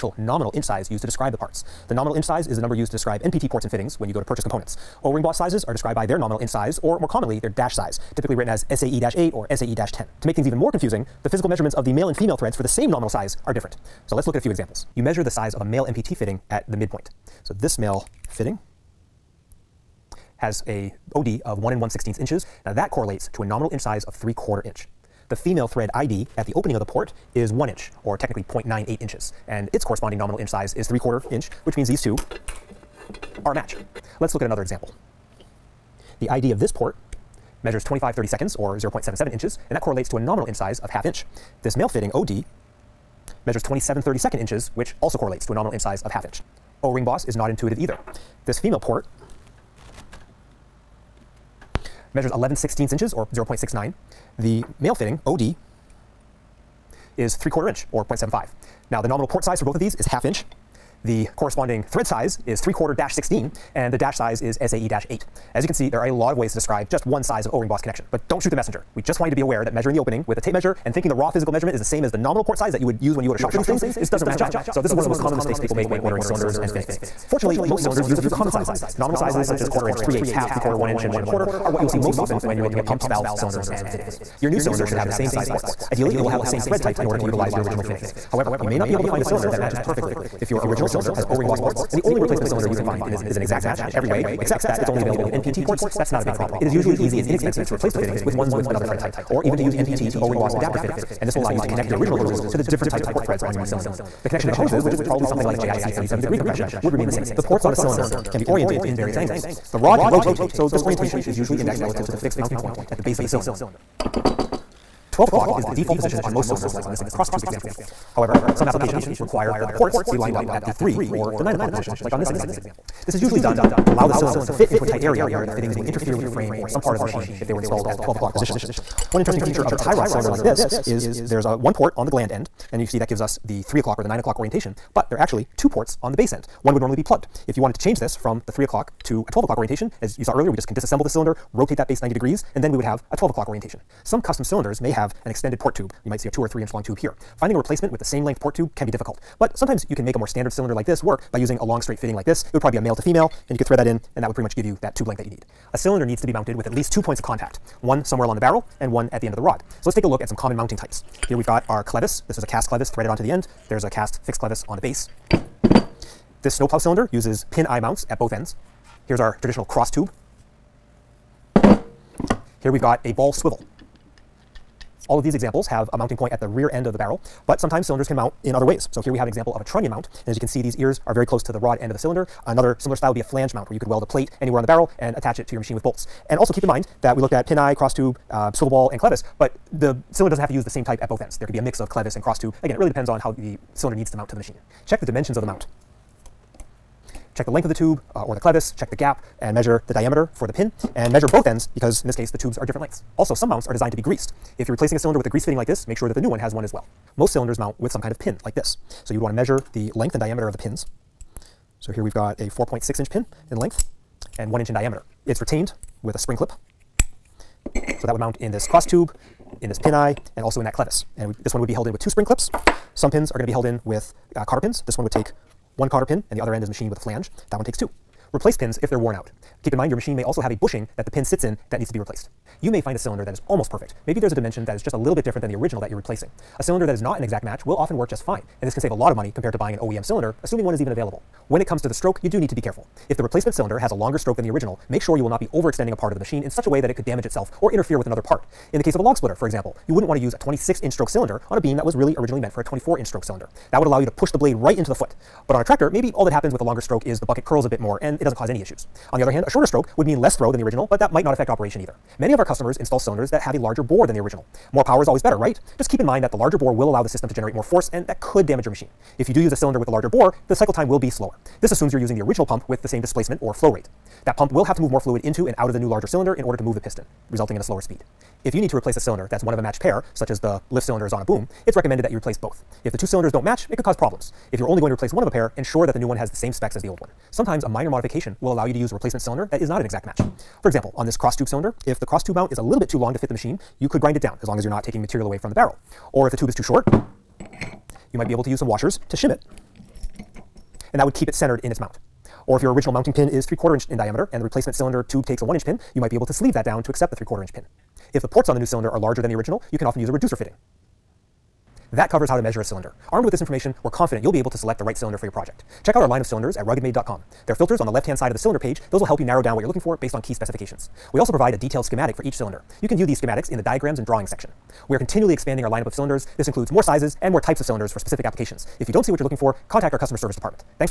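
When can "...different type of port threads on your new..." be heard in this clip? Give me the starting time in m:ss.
1:42.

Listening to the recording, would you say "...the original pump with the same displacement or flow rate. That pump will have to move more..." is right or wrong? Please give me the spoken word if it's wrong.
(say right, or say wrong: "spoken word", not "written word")
right.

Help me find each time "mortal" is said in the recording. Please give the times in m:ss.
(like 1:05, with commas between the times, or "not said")
not said.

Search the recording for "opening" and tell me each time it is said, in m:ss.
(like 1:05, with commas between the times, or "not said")
0:26, 1:09.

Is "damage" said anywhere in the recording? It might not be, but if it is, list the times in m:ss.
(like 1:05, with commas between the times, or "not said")
4:07, 4:28.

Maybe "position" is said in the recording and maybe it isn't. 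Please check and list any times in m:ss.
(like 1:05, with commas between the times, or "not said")
1:55, 2:01, 2:08.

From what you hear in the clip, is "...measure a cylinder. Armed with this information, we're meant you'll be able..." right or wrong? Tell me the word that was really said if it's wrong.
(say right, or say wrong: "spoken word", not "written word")
wrong: "confident", not "meant".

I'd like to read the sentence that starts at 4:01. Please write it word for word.
When it comes to the stroke, you do need to be careful.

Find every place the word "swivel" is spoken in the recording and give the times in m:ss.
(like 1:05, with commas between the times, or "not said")
2:53, 3:08.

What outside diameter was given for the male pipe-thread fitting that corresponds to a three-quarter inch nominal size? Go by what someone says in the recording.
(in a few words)
1 1/16 inches.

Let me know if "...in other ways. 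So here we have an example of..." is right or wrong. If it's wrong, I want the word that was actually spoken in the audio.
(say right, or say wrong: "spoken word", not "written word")
right.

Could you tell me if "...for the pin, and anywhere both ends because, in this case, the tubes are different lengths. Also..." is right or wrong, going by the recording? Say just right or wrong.
wrong.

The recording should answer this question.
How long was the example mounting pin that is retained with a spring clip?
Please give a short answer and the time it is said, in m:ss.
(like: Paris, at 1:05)
4.6 inches, at 3:32.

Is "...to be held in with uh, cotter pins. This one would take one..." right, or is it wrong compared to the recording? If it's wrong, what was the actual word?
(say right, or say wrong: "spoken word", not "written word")
right.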